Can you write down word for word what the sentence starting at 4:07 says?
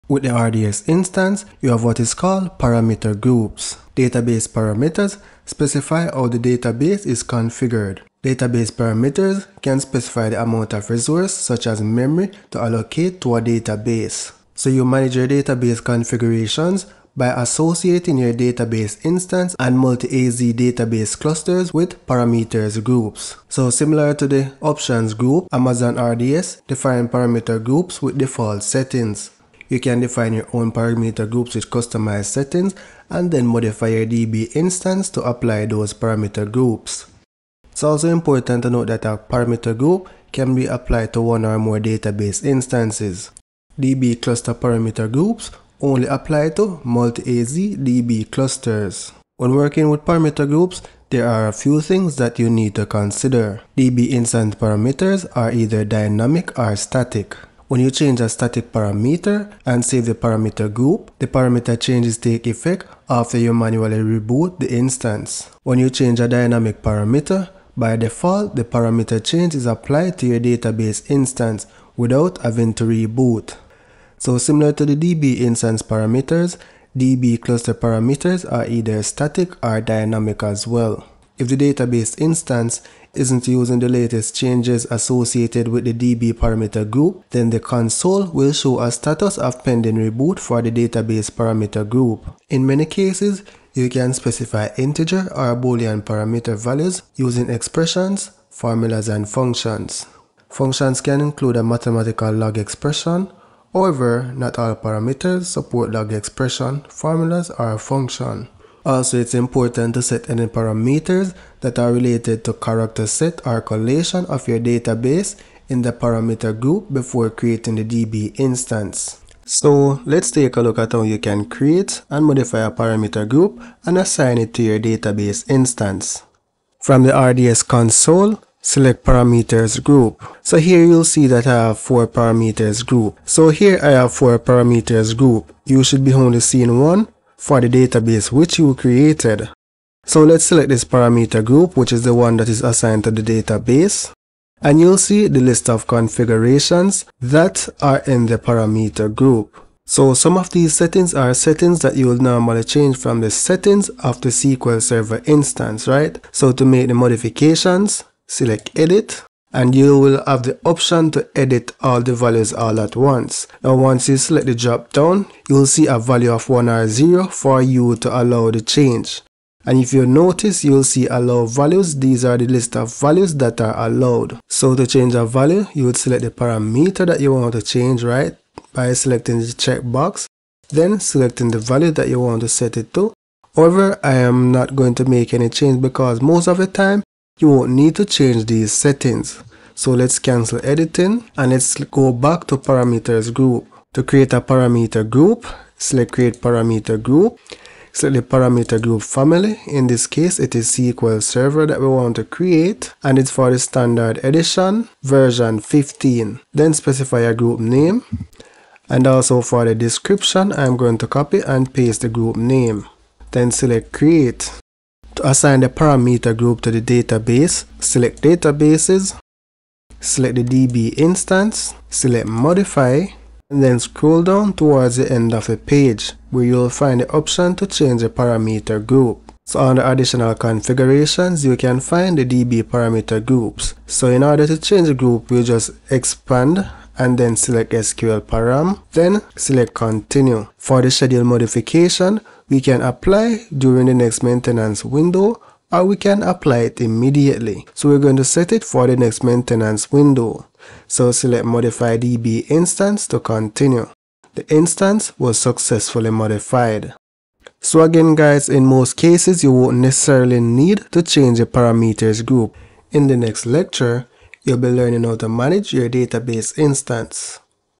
So we're going to set it for the next maintenance window.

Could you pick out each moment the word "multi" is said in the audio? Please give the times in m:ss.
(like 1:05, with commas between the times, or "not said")
0:19, 0:46.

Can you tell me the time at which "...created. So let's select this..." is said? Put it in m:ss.
2:18.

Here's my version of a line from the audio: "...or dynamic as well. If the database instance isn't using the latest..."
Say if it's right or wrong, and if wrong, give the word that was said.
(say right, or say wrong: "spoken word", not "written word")
right.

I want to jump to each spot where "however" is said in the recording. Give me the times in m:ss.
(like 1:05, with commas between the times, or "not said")
1:43, 3:03.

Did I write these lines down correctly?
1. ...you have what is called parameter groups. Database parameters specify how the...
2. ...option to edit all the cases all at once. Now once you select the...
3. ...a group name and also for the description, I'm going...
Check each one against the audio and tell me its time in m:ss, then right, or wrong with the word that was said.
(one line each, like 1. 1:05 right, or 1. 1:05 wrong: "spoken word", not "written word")
1. 0:01 right
2. 2:40 wrong: "values", not "cases"
3. 3:27 right.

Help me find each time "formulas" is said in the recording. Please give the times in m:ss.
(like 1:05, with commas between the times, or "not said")
1:38, 1:46.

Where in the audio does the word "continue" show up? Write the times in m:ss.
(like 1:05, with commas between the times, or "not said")
3:59, 4:13.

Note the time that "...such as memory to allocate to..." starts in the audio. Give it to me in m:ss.
0:11.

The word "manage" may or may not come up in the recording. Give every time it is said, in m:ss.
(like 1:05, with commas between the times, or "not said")
0:14, 4:25.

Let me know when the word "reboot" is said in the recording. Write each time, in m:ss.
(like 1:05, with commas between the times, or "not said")
1:03, 1:12, 1:29.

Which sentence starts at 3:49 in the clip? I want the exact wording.
So under additional configurations, you can find the DB parameter groups.